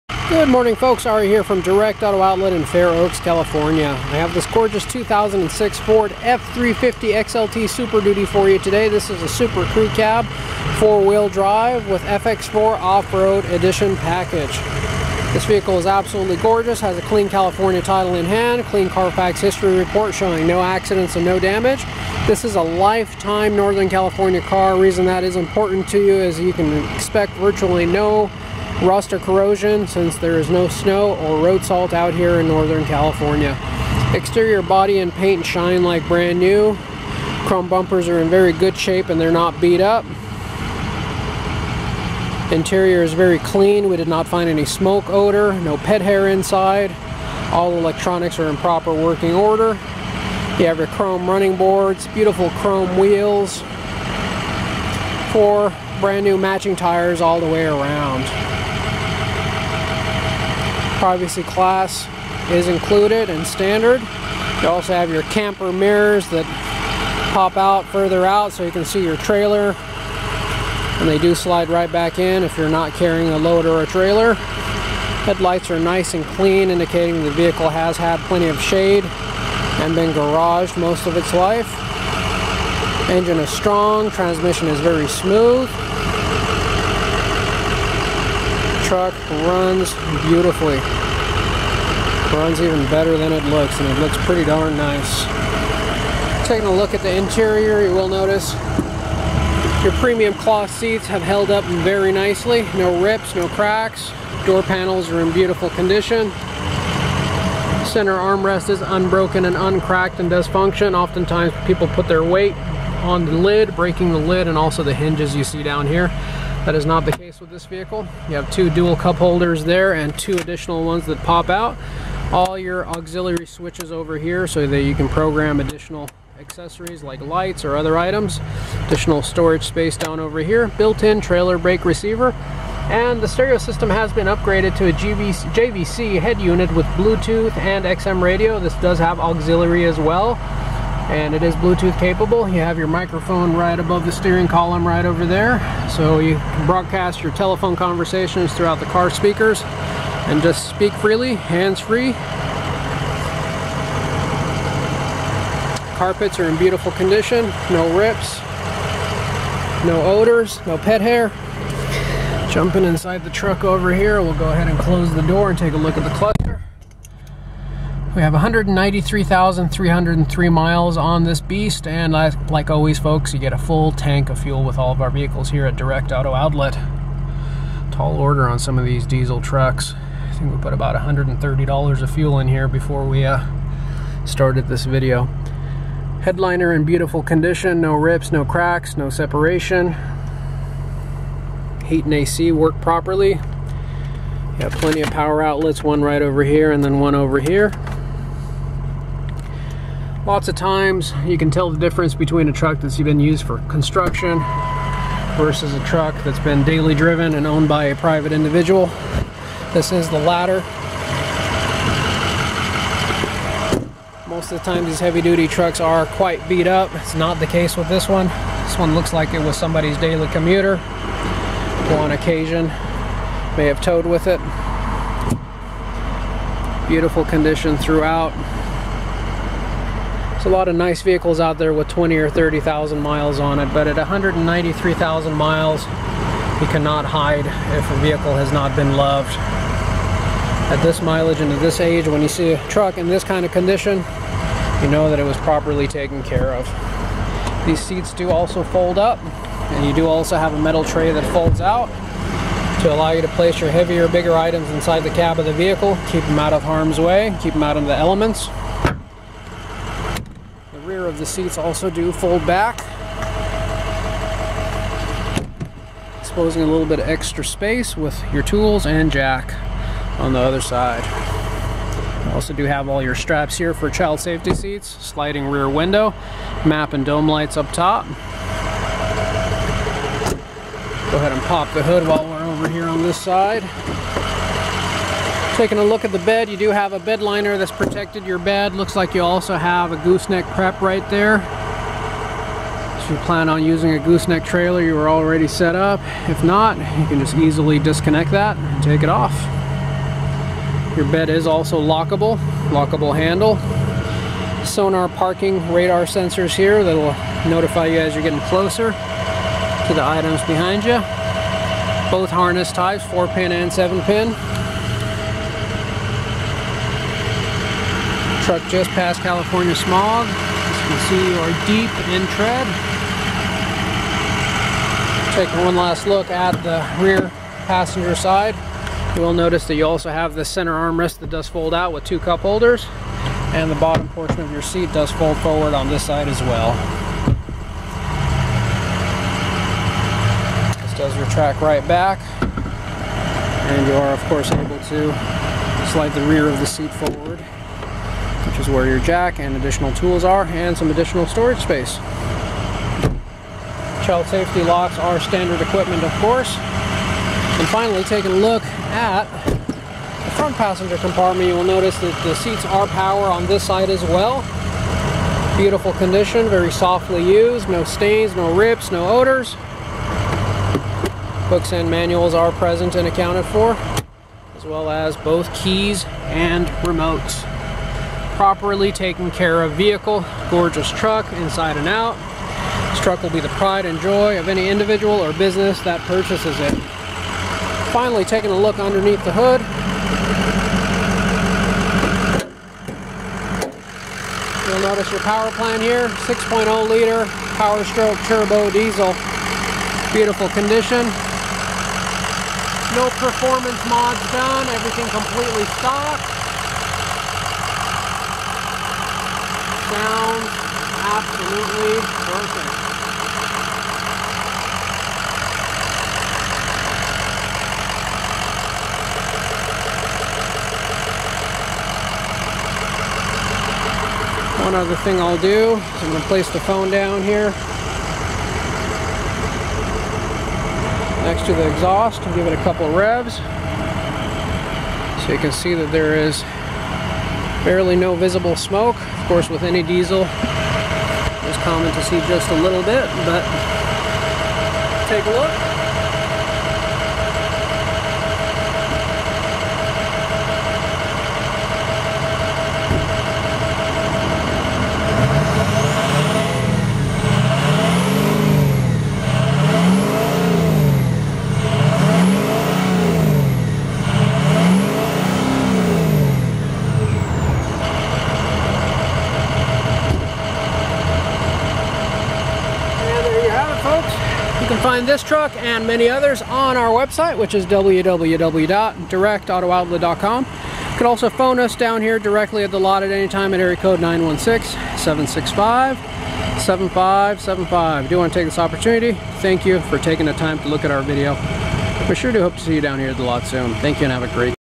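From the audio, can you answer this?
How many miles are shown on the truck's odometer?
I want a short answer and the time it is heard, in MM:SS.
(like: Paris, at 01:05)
193,303, at 02:48.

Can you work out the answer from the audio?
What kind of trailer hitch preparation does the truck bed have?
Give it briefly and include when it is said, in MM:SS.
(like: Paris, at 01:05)
gooseneck prep, at 04:49.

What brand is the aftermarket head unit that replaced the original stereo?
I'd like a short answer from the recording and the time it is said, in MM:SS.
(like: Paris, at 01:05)
JVC, at 02:15.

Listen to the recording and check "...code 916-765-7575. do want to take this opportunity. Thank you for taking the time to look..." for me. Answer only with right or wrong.
right.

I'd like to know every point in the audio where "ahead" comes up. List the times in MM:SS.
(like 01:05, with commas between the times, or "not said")
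02:44, 04:41.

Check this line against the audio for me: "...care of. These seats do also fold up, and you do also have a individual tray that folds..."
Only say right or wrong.
wrong.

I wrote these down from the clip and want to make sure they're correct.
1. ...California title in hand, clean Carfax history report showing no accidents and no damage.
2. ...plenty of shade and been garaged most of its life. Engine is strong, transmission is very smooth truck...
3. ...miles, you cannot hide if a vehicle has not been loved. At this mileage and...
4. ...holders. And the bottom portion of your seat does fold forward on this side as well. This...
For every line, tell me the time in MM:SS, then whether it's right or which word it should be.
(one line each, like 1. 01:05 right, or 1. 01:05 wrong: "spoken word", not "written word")
1. 00:17 right
2. 01:18 right
3. 03:55 right
4. 05:32 right.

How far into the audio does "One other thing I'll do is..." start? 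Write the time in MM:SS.
07:04.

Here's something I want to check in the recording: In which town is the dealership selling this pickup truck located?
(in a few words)
Fair Oaks, California.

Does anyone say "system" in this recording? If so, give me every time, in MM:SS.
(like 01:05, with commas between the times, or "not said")
02:13.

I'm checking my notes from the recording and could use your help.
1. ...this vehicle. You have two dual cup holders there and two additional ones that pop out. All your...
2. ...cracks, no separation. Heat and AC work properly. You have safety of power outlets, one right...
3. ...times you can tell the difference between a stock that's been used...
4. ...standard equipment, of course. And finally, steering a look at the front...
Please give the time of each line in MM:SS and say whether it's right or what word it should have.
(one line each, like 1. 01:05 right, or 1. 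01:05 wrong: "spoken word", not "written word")
1. 01:57 right
2. 03:08 wrong: "plenty", not "safety"
3. 03:20 wrong: "truck", not "stock"
4. 05:55 wrong: "taking", not "steering".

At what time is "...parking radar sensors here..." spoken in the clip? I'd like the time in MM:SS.
05:05.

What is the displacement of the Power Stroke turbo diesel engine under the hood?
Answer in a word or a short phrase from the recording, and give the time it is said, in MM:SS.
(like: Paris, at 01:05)
6.0 liter, at 06:36.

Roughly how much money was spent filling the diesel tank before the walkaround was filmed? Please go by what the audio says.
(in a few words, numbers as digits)
$130.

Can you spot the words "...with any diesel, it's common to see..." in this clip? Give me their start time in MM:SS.
07:19.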